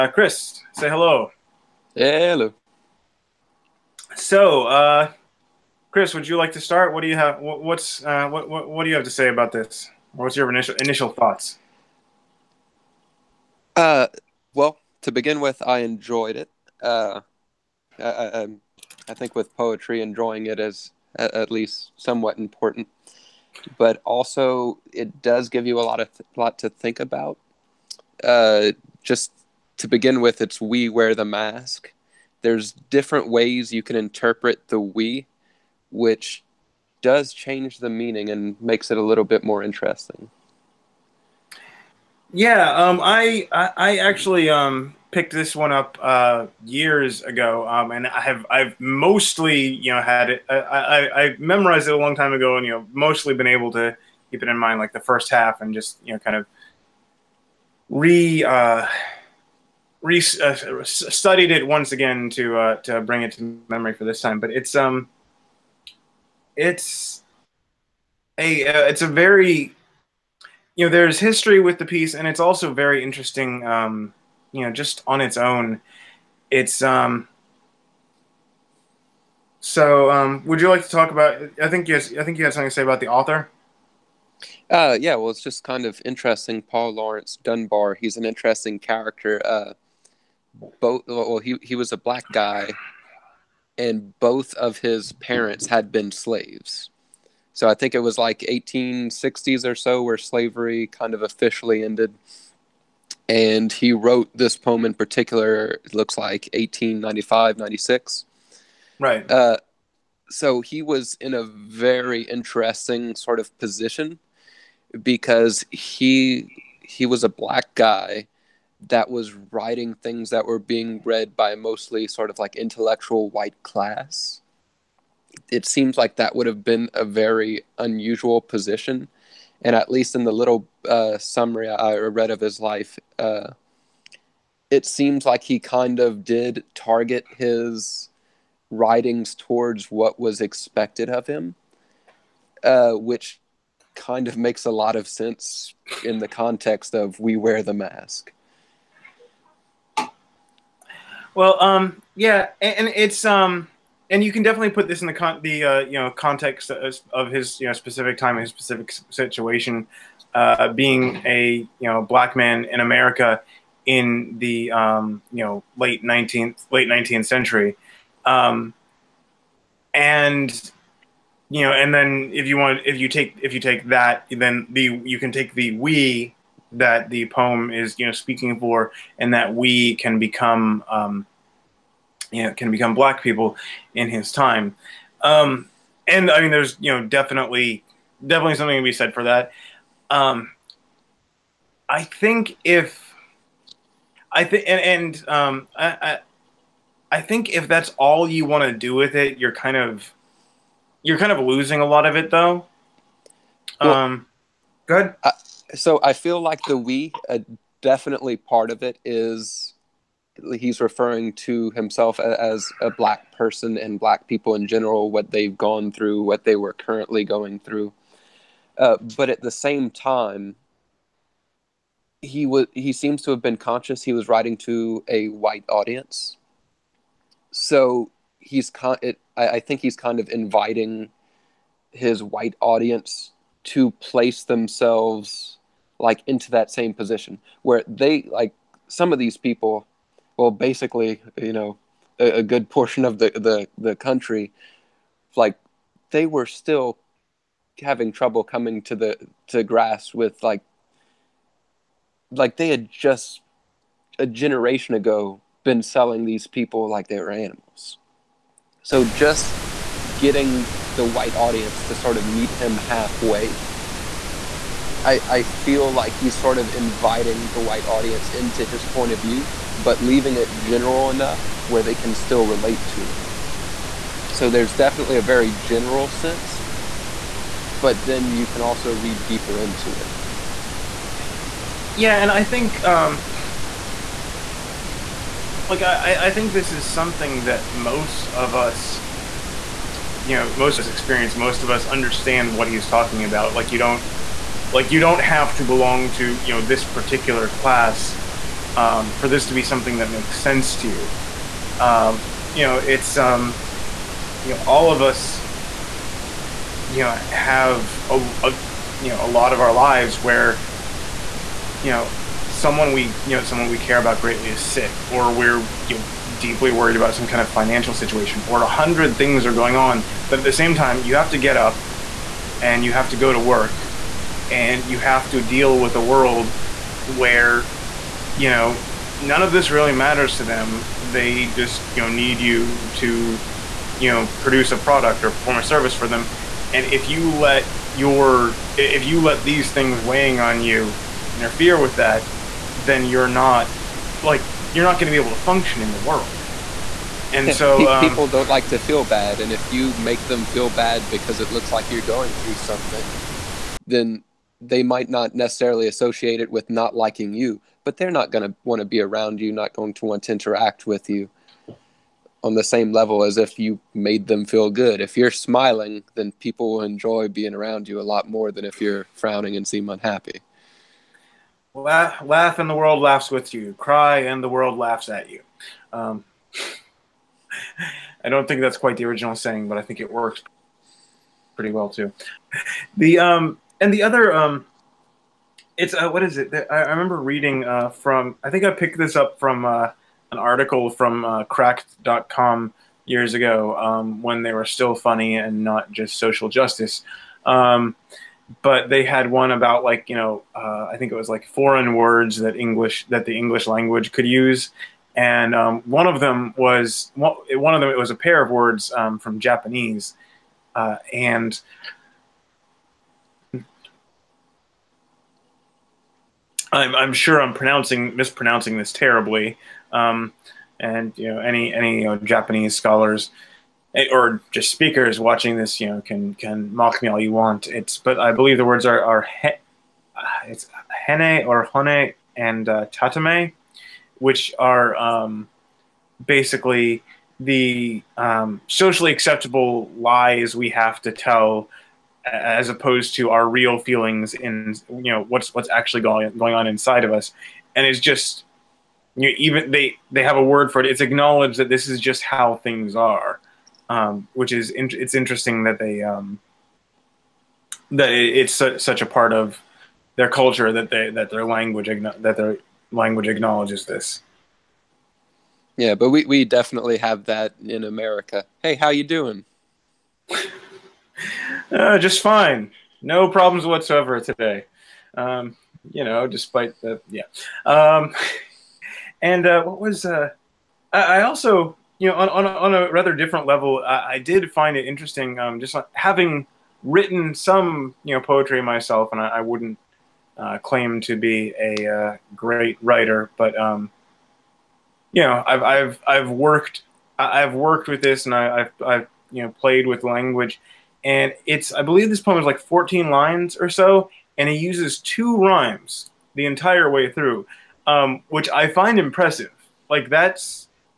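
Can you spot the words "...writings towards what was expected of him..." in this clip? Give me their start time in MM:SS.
02:18.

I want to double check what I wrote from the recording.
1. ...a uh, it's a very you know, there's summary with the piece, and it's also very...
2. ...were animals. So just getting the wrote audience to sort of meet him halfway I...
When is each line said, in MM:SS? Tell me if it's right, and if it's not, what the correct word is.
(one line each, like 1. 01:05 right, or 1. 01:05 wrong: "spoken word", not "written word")
1. 01:08 wrong: "history", not "summary"
2. 04:17 wrong: "white", not "wrote".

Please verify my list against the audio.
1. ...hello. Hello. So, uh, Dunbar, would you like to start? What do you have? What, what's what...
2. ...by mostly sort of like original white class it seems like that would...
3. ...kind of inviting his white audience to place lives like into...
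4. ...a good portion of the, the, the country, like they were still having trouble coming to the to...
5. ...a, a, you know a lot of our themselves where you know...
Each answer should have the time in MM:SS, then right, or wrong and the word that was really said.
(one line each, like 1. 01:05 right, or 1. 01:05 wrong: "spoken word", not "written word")
1. 00:00 wrong: "Chris", not "Dunbar"
2. 02:01 wrong: "intellectual", not "original"
3. 03:49 wrong: "themselves", not "lives"
4. 04:02 right
5. 05:08 wrong: "lives", not "themselves".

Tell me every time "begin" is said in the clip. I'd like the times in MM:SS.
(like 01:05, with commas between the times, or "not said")
00:15, 00:29.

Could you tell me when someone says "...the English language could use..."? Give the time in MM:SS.
06:43.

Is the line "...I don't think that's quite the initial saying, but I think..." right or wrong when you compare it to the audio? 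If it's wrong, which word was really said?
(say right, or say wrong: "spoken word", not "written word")
wrong: "original", not "initial".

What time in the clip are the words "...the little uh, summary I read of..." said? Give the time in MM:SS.
02:10.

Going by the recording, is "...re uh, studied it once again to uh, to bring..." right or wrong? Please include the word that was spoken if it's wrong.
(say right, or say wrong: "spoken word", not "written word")
right.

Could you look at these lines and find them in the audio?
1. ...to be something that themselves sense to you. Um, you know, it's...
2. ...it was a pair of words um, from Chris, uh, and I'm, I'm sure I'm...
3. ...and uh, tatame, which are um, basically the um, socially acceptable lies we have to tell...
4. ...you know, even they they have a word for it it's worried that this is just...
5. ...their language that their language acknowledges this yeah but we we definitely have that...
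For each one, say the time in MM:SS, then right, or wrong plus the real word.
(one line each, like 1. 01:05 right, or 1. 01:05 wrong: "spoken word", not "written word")
1. 04:59 wrong: "makes", not "themselves"
2. 06:47 wrong: "Japanese", not "Chris"
3. 07:12 right
4. 07:29 wrong: "acknowledged", not "worried"
5. 07:41 right.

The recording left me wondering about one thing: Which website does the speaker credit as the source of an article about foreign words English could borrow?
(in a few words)
Cracked.com.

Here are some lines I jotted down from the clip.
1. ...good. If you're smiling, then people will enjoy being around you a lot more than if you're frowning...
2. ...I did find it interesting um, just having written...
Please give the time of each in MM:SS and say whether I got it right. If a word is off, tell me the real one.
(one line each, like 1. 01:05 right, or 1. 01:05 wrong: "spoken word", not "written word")
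1. 06:04 right
2. 08:04 right.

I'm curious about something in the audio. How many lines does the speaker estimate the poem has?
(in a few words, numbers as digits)
14.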